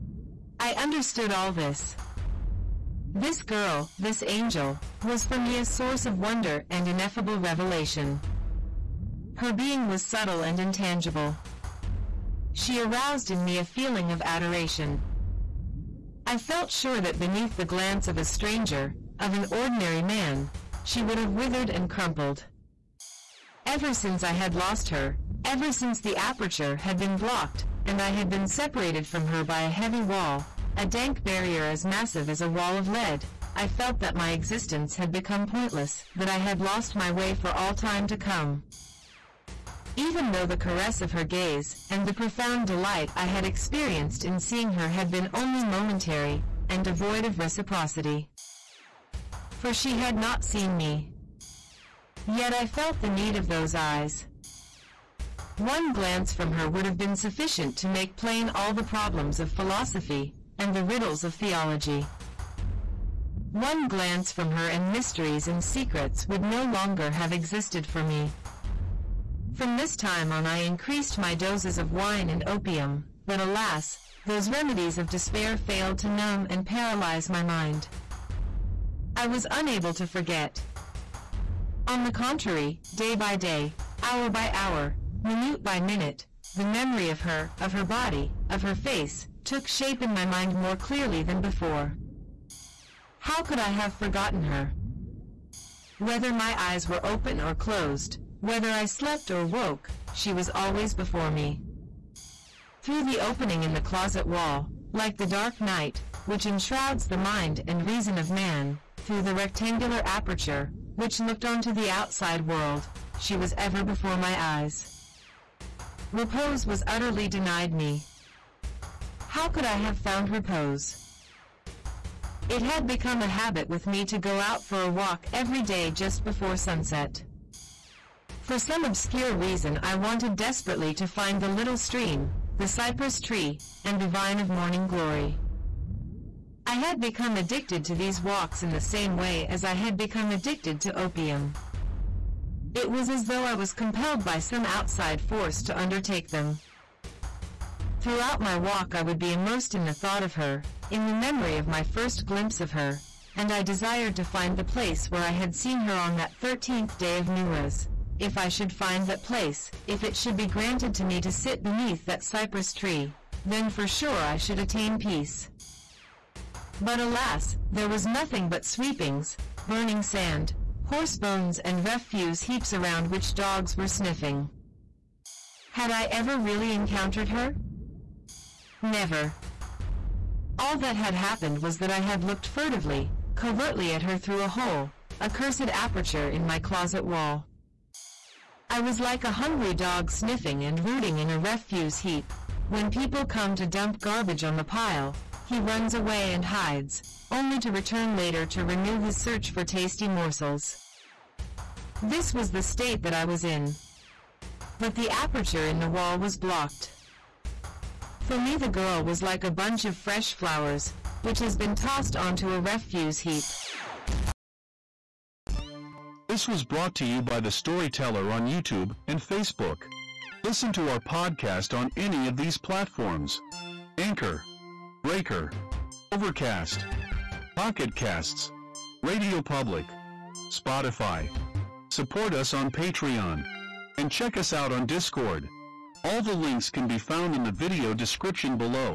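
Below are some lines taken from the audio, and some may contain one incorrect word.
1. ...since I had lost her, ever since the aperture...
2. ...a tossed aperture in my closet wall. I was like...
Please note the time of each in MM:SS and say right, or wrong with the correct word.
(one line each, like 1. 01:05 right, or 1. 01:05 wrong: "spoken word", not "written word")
1. 00:23 right
2. 03:05 wrong: "cursed", not "tossed".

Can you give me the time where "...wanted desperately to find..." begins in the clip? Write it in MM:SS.
02:09.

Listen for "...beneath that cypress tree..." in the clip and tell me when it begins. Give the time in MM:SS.
02:41.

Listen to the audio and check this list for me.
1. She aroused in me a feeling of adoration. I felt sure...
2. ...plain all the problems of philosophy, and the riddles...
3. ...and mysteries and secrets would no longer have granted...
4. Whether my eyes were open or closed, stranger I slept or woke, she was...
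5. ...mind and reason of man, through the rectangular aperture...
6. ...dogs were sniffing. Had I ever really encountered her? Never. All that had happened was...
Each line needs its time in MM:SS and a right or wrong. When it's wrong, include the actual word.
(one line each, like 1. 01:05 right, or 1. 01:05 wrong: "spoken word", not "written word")
1. 00:12 right
2. 00:58 right
3. 01:04 wrong: "existed", not "granted"
4. 01:35 wrong: "whether", not "stranger"
5. 01:47 right
6. 02:53 right.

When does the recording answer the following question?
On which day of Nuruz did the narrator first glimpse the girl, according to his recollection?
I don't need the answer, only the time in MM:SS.
02:36.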